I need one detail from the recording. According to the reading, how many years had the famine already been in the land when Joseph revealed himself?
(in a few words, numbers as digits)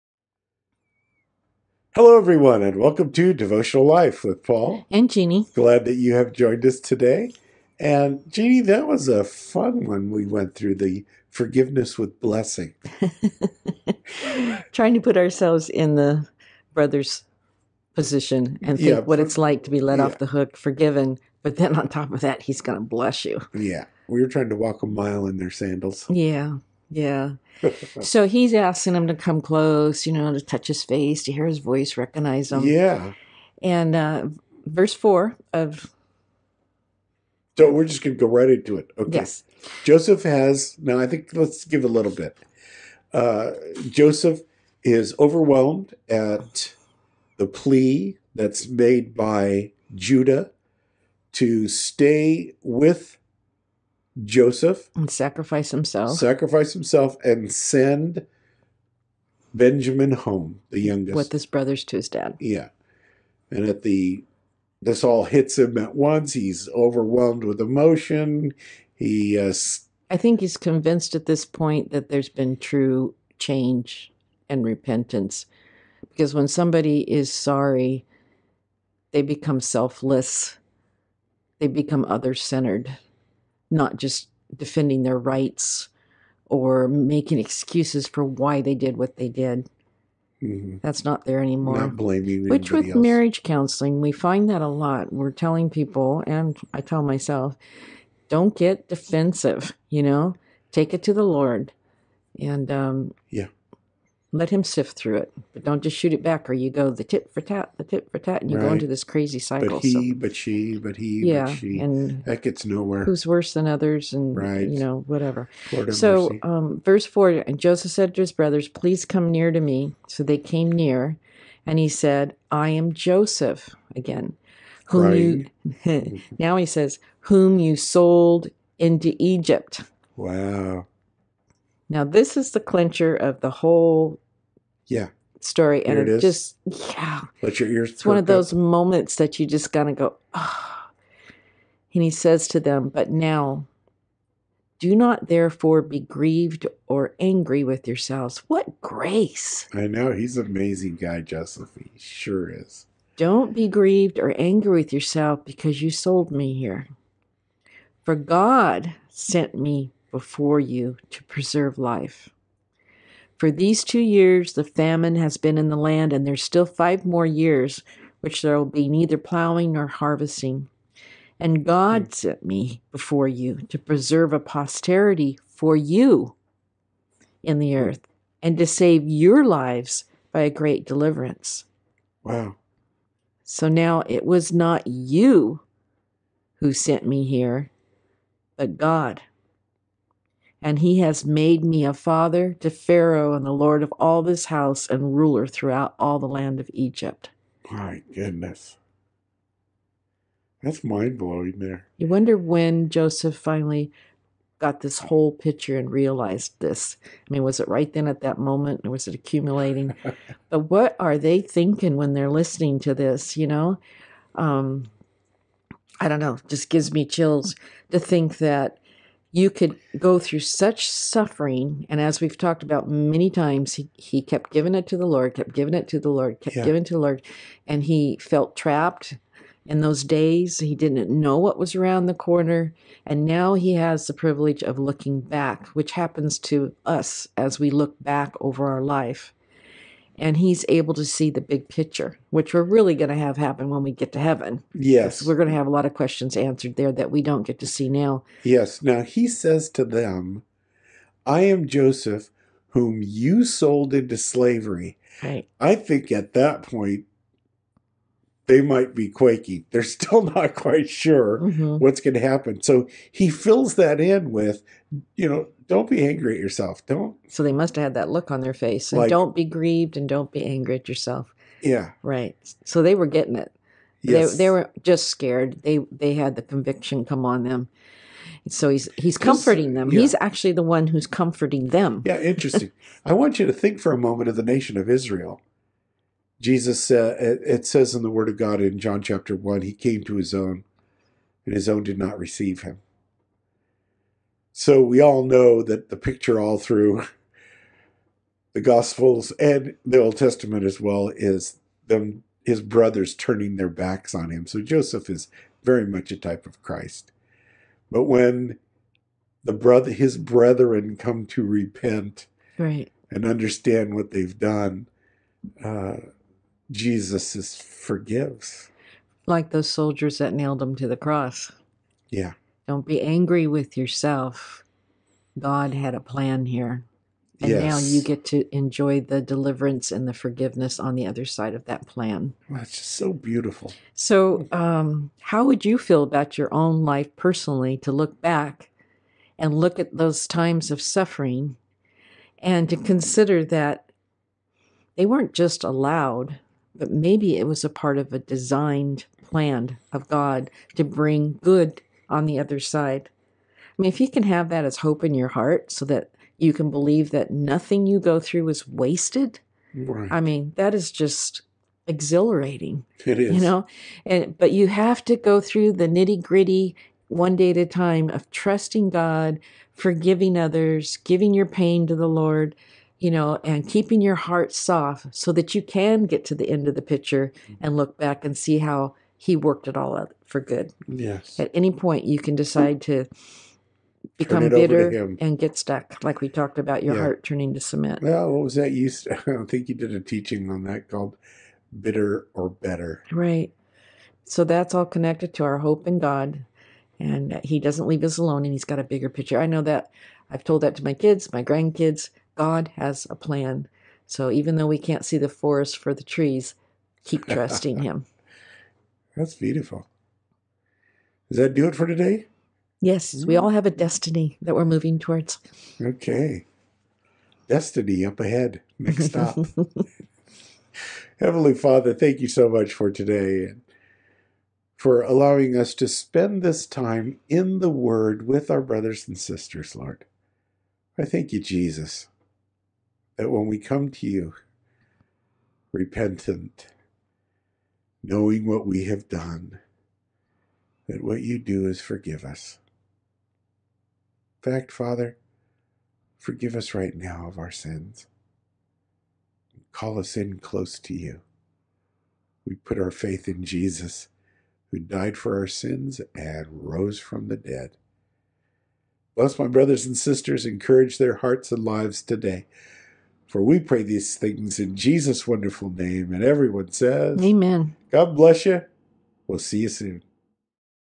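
2.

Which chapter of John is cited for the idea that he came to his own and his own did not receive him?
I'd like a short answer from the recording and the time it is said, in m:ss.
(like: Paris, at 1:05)
Chapter 1, at 4:49.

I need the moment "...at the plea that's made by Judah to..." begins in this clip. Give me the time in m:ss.
0:46.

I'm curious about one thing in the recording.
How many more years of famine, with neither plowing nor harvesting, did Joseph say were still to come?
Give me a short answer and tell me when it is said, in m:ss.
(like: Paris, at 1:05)
5, at 2:46.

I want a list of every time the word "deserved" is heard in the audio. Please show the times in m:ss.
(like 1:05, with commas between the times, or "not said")
not said.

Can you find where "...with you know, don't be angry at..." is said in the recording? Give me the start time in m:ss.
4:24.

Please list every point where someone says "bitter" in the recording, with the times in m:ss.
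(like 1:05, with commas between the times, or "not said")
6:24, 6:31.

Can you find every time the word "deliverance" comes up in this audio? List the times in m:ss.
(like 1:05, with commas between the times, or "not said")
3:00, 5:29.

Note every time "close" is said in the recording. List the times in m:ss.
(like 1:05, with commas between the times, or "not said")
0:29, 7:30.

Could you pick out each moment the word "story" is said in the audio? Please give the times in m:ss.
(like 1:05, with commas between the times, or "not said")
2:15.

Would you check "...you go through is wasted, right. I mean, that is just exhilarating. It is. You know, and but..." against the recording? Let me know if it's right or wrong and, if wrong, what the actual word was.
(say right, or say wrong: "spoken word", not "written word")
right.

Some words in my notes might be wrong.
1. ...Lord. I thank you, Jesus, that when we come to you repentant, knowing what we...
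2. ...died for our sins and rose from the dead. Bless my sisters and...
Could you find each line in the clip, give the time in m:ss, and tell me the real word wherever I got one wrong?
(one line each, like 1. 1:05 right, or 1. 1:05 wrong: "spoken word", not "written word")
1. 7:09 right
2. 7:34 wrong: "brothers", not "sisters".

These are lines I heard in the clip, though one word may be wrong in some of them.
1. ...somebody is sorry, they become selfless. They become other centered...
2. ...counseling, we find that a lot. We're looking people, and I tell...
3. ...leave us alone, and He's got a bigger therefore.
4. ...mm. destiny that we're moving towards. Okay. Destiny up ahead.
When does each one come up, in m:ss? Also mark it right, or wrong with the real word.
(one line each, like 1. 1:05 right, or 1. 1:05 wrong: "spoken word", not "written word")
1. 1:16 right
2. 1:33 wrong: "telling", not "looking"
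3. 6:37 wrong: "picture", not "therefore"
4. 6:53 right.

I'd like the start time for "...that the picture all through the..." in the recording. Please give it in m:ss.
4:55.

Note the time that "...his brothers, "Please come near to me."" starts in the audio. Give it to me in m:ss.
1:58.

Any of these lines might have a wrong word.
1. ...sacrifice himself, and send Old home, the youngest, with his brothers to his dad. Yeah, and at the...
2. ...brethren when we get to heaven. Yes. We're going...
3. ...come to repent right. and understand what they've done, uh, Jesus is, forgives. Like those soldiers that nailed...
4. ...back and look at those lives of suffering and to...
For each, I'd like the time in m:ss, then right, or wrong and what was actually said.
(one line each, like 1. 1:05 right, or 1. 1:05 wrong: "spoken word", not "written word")
1. 0:56 wrong: "Benjamin", not "Old"
2. 4:03 wrong: "happen", not "brethren"
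3. 5:10 right
4. 5:38 wrong: "times", not "lives".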